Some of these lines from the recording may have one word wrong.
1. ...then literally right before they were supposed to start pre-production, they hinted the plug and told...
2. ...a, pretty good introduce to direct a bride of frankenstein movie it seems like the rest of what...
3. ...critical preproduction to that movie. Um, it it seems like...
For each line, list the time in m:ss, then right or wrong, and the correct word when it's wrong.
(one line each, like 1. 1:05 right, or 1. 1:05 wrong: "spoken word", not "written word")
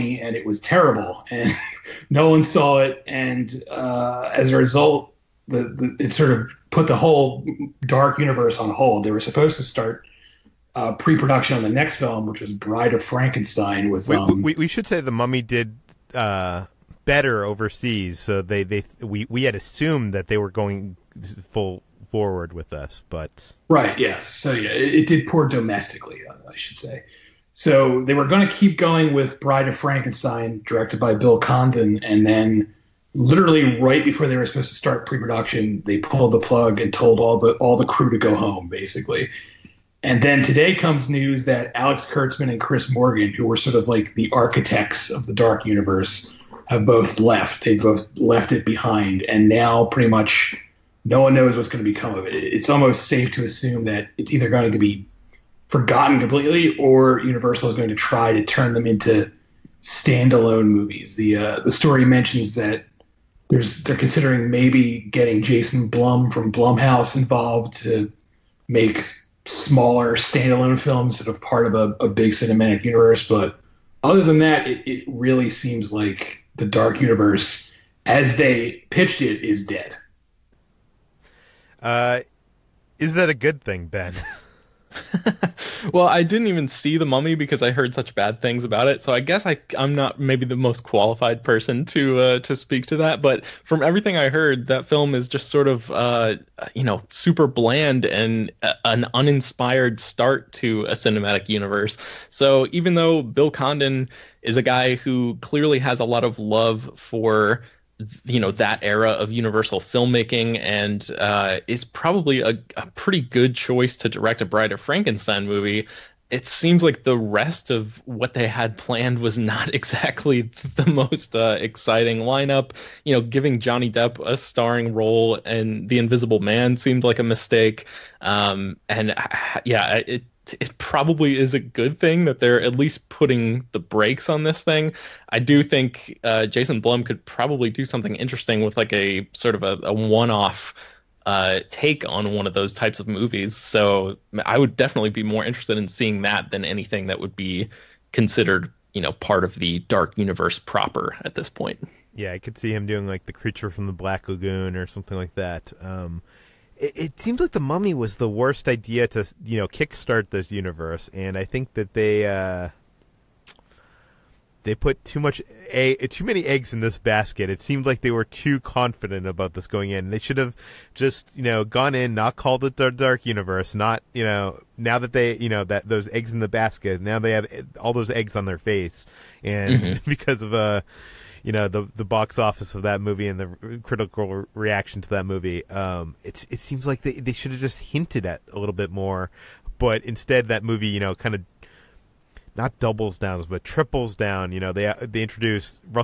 1. 0:32 wrong: "pulled", not "hinted"
2. 1:52 wrong: "choice", not "introduce"
3. 3:03 wrong: "reaction", not "preproduction".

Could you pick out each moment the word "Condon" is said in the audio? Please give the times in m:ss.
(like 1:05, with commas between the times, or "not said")
0:31, 1:43.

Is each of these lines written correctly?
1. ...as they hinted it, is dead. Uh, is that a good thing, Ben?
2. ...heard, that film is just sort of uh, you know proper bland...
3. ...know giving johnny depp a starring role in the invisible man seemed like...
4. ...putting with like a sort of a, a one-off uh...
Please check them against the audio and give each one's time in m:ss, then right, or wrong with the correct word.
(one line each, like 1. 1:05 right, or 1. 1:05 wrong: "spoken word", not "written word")
1. 1:18 wrong: "pitched", not "hinted"
2. 1:34 wrong: "super", not "proper"
3. 2:03 right
4. 2:18 wrong: "interesting", not "putting".